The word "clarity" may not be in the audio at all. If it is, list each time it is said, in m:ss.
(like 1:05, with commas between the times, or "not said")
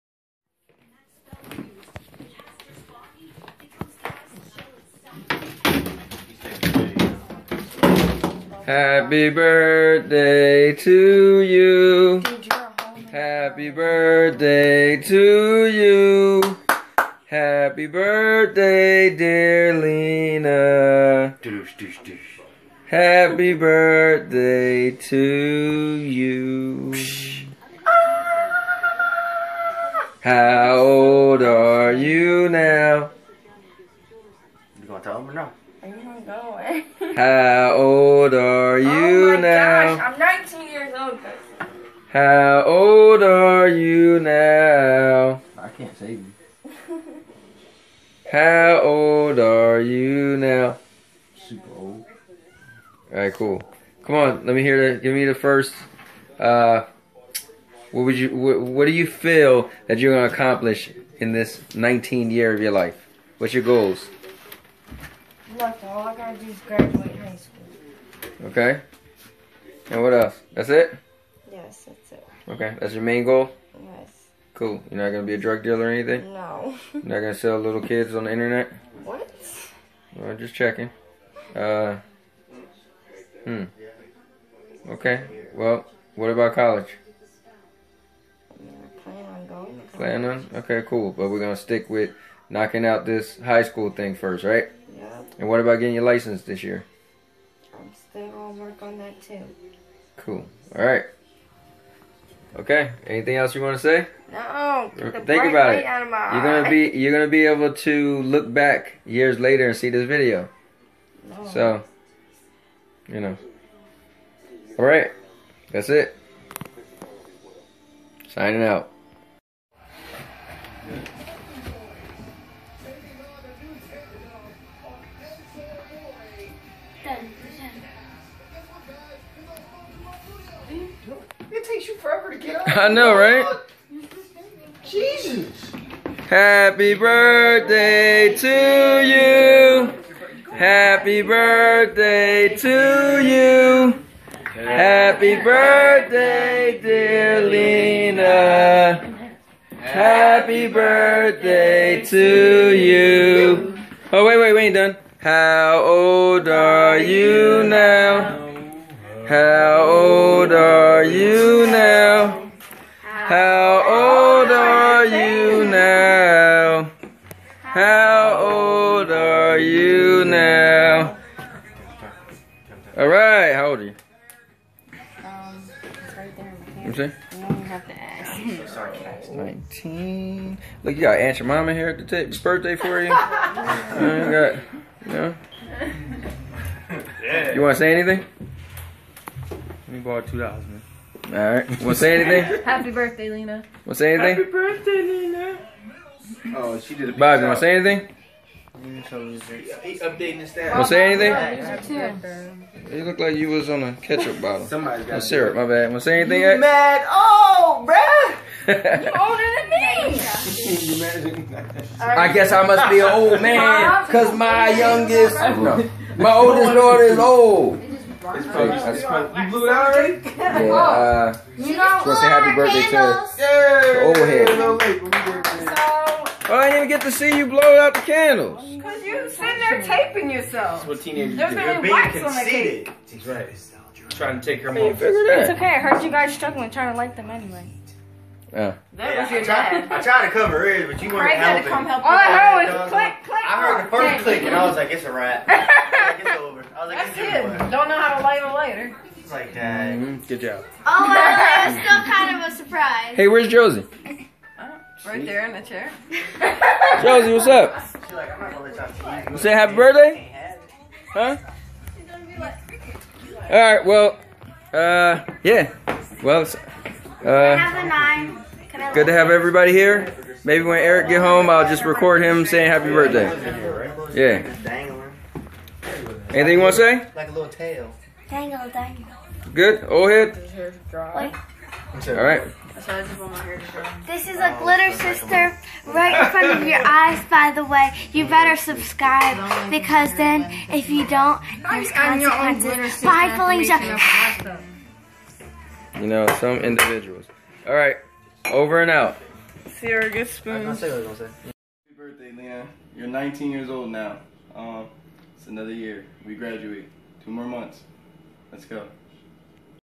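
not said.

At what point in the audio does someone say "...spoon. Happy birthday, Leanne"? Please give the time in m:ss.
5:00.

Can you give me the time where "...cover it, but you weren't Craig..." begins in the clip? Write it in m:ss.
4:00.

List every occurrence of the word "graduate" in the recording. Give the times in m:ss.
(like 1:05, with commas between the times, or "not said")
1:06, 5:06.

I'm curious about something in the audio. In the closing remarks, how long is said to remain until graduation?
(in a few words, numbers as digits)
2 months.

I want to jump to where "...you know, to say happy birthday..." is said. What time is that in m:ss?
3:41.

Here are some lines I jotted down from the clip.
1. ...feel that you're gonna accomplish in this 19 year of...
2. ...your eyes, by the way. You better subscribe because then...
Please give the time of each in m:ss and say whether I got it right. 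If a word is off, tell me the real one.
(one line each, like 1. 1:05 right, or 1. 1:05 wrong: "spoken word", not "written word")
1. 0:59 right
2. 4:46 right.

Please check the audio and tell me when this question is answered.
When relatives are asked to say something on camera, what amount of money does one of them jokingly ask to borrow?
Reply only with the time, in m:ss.
3:10.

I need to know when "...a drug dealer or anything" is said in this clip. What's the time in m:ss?
1:15.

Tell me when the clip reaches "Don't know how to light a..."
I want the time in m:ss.
4:07.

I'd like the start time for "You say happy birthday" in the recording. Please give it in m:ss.
4:19.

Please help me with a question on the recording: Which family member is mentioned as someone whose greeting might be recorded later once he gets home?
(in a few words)
Eric.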